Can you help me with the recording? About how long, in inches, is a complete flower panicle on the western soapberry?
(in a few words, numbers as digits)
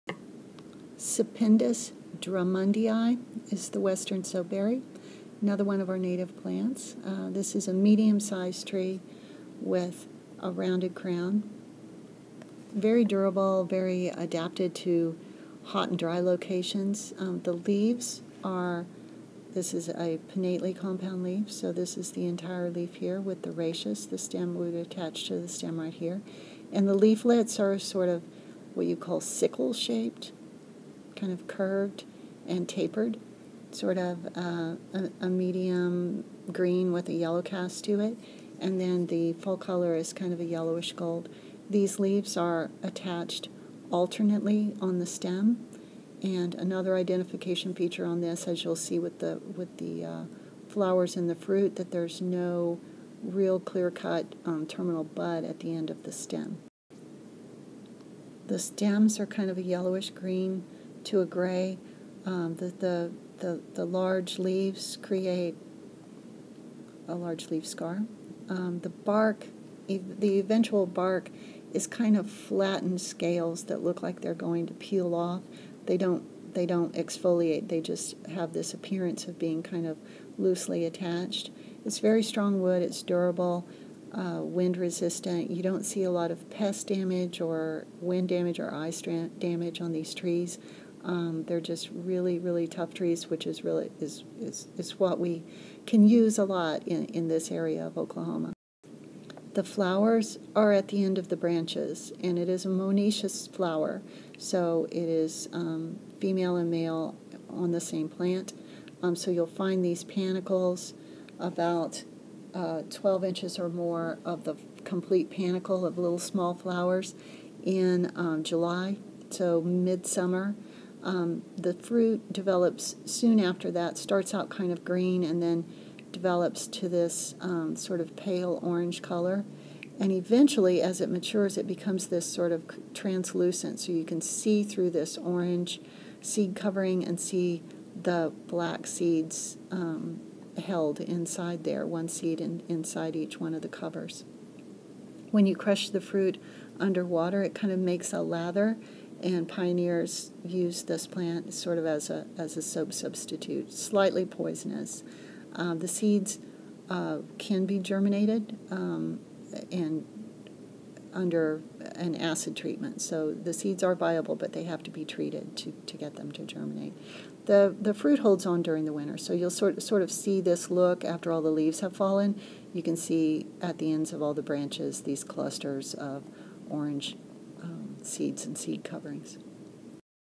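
12 inches.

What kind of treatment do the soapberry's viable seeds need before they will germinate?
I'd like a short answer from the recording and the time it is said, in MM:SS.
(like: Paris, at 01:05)
Acid treatment, at 02:42.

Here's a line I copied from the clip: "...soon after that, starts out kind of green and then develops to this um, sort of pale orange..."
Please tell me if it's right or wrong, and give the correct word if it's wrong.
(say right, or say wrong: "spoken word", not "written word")
right.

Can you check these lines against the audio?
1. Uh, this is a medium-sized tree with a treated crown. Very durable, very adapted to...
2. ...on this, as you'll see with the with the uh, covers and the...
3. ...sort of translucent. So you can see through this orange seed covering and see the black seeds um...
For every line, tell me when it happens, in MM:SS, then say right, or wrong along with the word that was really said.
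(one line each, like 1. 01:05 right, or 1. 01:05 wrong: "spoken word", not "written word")
1. 00:07 wrong: "rounded", not "treated"
2. 00:48 wrong: "flowers", not "covers"
3. 02:12 right.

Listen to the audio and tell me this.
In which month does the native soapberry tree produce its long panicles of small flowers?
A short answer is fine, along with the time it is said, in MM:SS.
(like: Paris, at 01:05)
July, at 01:58.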